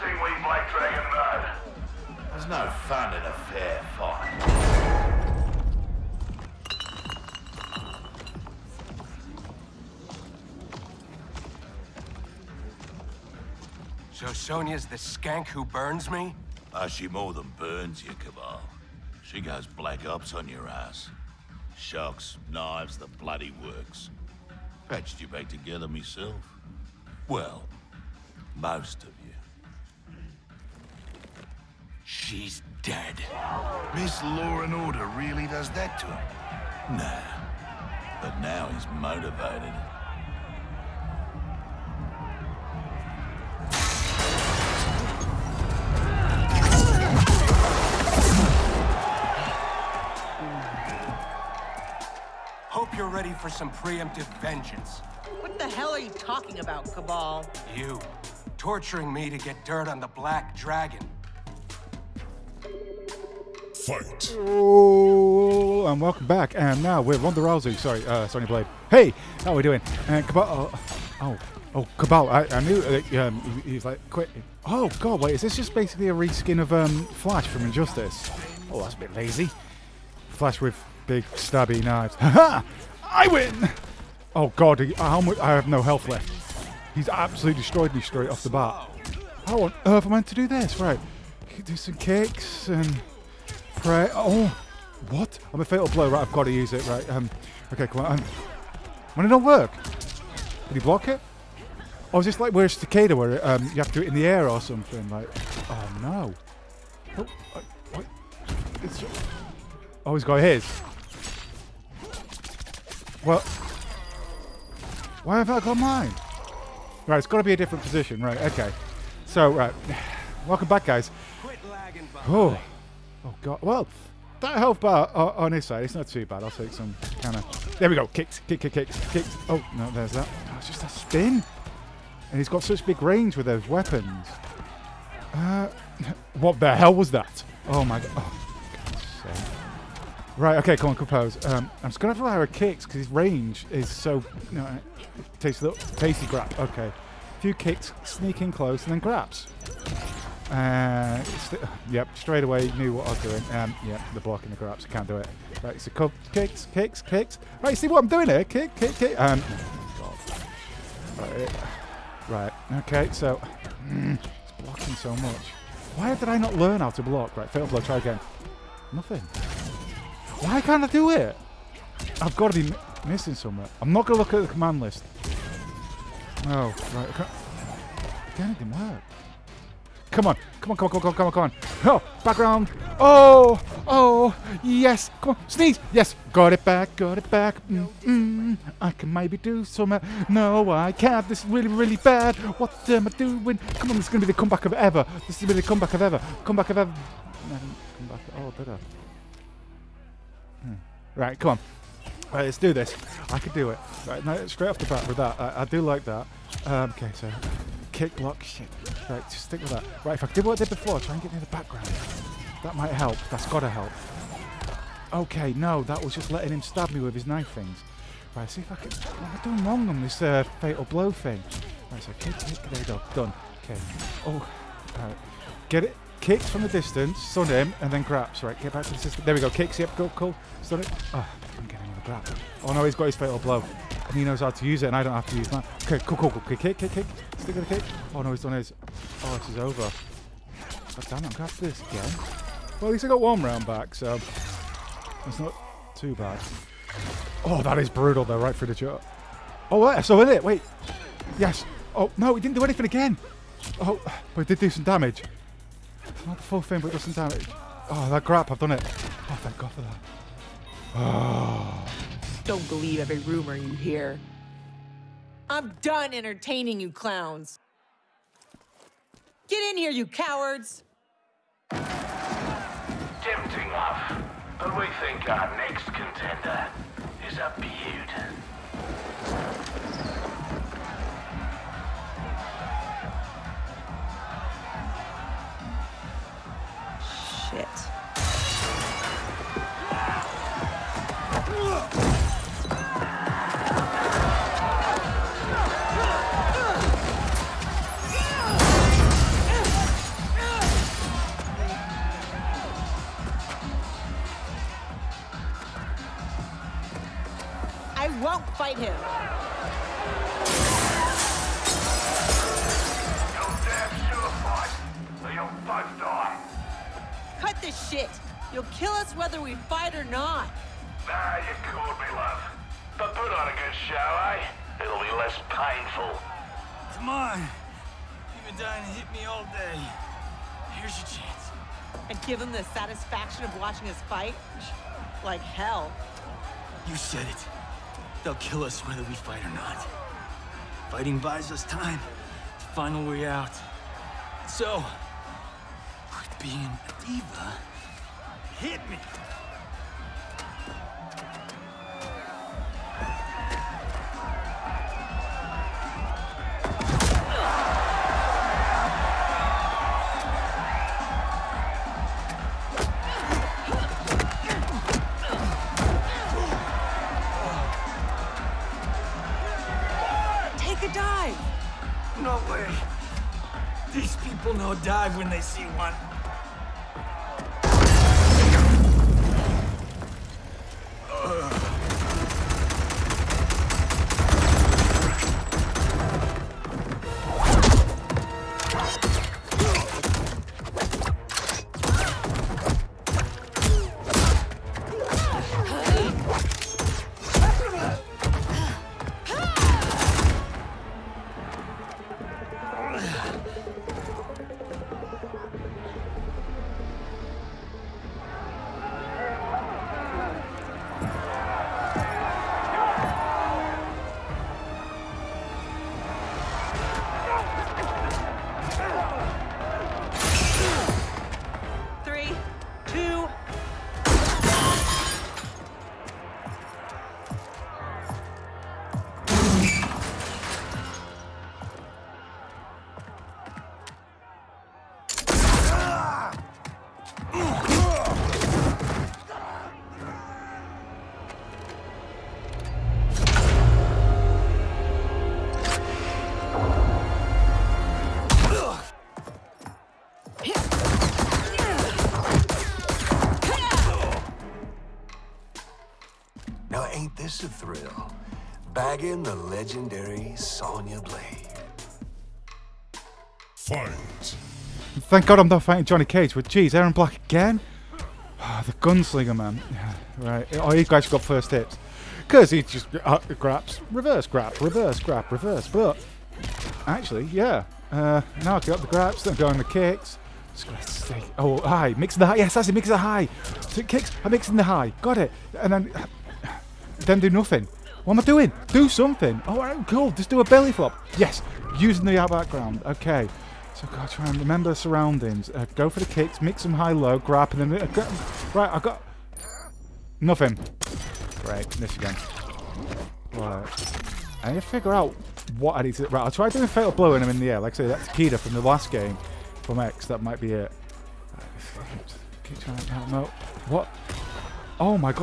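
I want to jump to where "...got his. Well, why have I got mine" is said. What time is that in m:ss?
1:50.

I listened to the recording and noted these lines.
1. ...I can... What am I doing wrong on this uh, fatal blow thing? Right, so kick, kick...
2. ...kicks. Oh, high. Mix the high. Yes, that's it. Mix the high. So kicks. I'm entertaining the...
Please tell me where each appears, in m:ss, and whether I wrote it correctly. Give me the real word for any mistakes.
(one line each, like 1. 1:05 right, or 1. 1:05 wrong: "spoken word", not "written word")
1. 3:38 right
2. 7:59 wrong: "mixing", not "entertaining".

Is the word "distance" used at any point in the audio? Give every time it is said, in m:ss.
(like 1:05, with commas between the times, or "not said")
3:46.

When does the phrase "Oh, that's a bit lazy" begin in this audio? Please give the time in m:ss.
1:18.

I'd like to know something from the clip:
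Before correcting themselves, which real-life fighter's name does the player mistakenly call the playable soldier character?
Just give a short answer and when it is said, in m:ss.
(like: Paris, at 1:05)
Ronda Rousey, at 1:07.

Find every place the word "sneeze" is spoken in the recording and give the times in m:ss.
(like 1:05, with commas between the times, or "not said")
3:05.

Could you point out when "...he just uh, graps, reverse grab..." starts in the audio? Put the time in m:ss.
7:52.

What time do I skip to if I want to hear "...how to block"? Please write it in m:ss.
2:46.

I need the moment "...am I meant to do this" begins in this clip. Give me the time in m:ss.
1:30.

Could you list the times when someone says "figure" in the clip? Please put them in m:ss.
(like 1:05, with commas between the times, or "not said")
8:24.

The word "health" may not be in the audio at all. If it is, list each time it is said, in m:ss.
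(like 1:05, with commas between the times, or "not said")
1:25, 2:04.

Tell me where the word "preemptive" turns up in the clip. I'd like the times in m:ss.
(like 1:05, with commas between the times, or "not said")
0:53.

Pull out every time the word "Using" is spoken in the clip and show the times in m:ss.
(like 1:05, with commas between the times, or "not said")
8:11.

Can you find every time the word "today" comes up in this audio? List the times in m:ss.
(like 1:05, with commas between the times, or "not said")
not said.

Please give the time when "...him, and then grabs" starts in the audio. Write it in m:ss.
3:47.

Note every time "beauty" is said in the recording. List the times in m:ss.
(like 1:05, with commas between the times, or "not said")
4:37.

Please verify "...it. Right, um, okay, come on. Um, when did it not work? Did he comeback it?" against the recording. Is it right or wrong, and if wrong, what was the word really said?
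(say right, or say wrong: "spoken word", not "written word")
wrong: "block", not "comeback".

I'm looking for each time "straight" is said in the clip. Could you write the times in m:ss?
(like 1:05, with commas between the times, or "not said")
1:28, 2:32, 3:24.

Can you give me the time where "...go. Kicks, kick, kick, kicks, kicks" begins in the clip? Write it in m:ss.
2:07.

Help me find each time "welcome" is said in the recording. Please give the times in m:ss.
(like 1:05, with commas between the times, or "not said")
1:06, 2:00.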